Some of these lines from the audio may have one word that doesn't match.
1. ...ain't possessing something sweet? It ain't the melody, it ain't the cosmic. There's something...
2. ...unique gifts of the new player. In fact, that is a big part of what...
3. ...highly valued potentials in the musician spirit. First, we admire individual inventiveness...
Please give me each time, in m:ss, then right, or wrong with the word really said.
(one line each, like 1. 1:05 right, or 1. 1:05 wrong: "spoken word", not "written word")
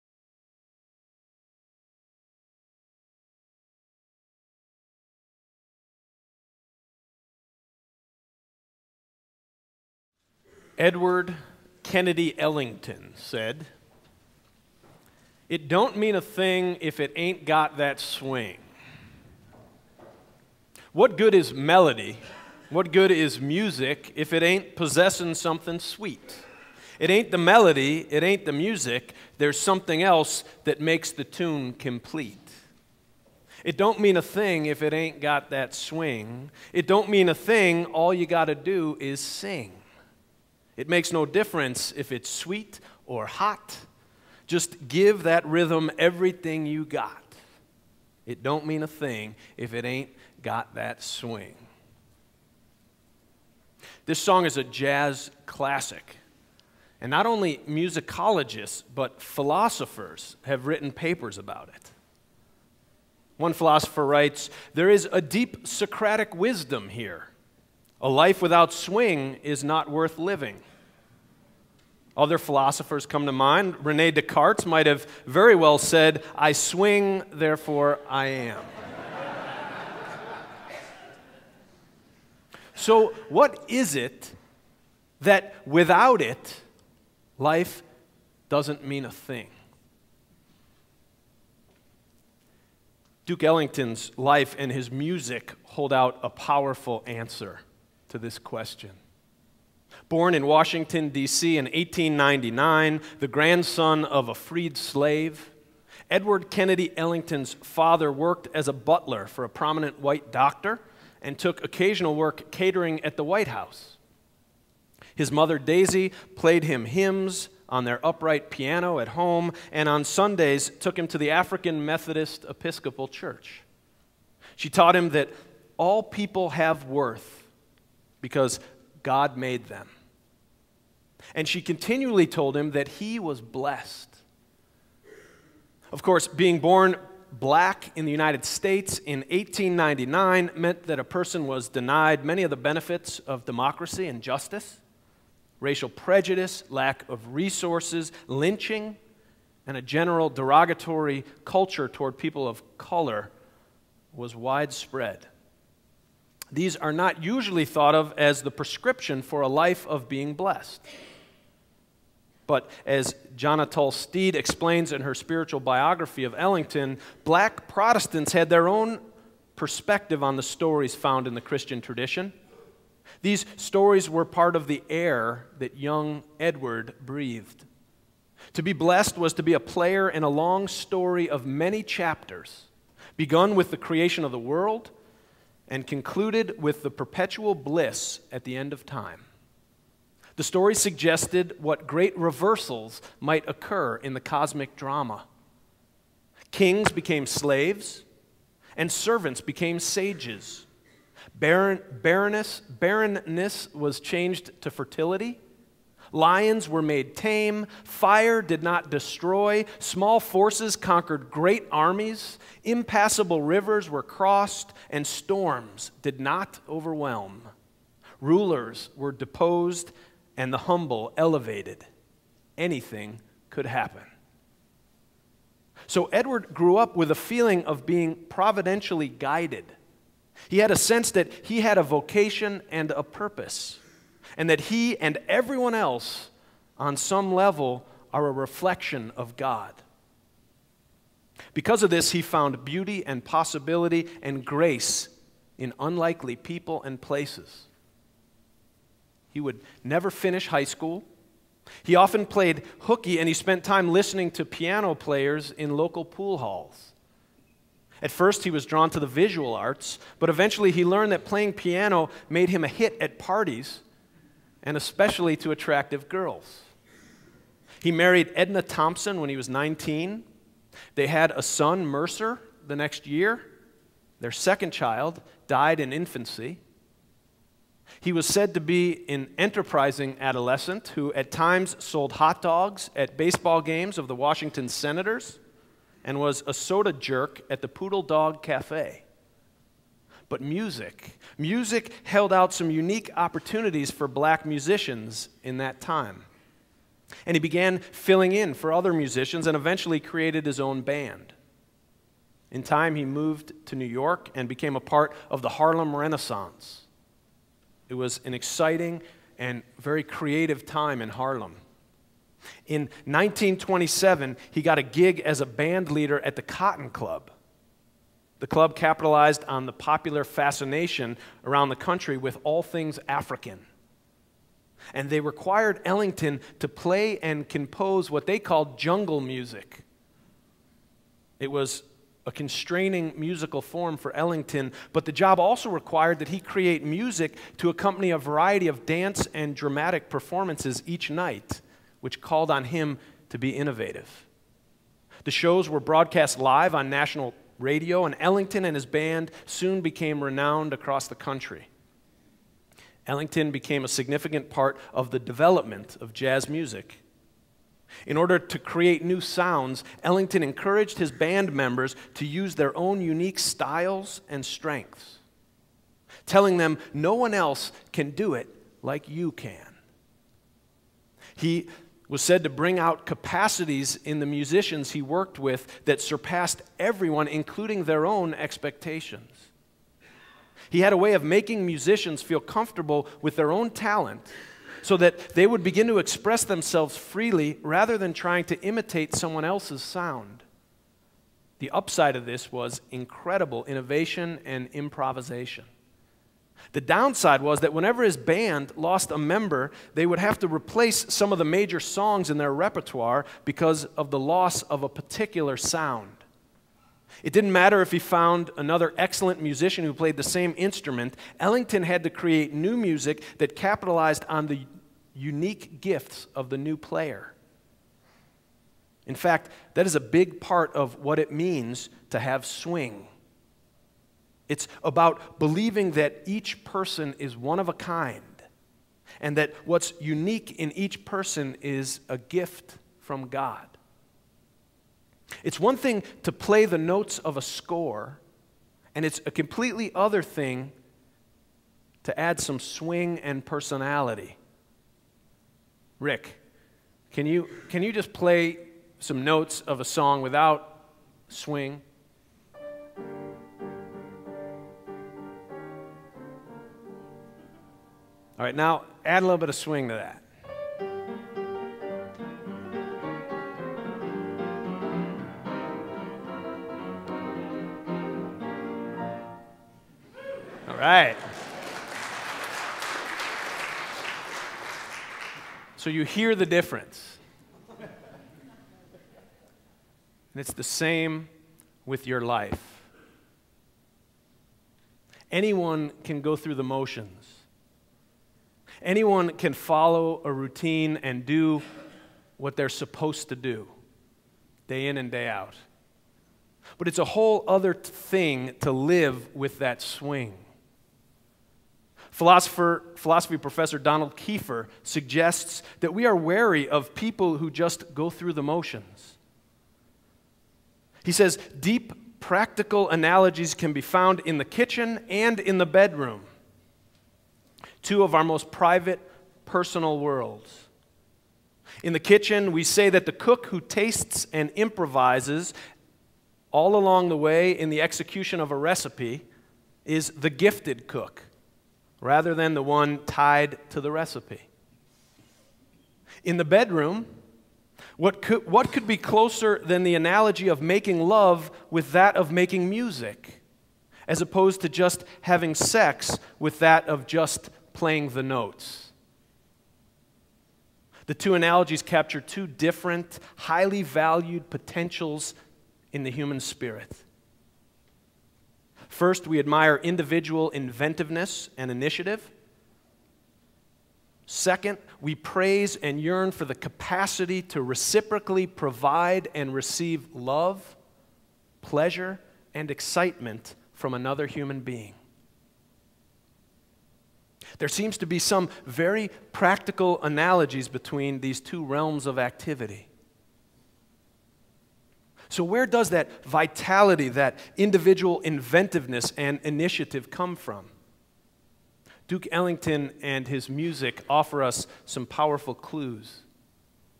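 1. 0:24 wrong: "music", not "cosmic"
2. 6:55 right
3. 9:13 wrong: "human", not "musician".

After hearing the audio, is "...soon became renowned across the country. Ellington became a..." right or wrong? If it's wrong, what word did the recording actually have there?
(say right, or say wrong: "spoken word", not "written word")
right.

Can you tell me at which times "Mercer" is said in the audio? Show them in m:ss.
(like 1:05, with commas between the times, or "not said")
4:31.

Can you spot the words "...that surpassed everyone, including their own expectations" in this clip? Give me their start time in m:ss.
6:15.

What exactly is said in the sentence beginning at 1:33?
Duke Ellington's life and his music hold out a powerful answer to this question.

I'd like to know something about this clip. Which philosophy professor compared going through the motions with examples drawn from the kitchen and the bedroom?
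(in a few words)
Donald Kiefer.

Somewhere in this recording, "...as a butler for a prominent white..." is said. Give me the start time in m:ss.
1:48.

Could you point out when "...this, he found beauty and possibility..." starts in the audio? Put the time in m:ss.
4:01.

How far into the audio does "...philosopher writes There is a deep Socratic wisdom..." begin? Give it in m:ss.
1:03.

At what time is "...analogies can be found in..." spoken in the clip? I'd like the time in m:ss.
8:32.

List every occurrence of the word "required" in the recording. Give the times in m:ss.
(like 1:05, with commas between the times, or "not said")
5:25, 5:35.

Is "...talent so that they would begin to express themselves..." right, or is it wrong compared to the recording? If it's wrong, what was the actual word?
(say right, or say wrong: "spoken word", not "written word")
right.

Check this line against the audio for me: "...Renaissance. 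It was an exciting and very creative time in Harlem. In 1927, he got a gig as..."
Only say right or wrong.
right.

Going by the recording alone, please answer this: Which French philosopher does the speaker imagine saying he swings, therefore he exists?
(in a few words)
Rene Descartes.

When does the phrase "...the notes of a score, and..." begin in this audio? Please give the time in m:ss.
7:16.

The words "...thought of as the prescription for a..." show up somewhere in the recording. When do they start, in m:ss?
2:37.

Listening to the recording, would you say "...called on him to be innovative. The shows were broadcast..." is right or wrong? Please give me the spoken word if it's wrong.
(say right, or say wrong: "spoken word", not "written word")
right.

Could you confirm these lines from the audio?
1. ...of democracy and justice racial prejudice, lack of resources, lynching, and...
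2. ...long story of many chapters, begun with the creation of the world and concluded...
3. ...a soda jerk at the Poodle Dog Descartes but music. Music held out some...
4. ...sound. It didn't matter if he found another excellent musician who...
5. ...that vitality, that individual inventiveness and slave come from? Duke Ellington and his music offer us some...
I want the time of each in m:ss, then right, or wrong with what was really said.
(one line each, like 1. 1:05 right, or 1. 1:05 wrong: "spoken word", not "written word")
1. 2:23 right
2. 3:00 right
3. 4:46 wrong: "Cafe", not "Descartes"
4. 6:45 right
5. 9:45 wrong: "initiative", not "slave".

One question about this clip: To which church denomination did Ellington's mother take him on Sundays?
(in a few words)
African Methodist Episcopal.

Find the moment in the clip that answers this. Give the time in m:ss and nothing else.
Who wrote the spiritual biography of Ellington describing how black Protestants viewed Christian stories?
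2:43.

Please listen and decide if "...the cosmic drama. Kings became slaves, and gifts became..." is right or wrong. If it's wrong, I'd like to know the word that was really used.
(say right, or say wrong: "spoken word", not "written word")
wrong: "servants", not "gifts".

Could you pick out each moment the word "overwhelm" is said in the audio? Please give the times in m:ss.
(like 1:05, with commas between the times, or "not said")
3:36.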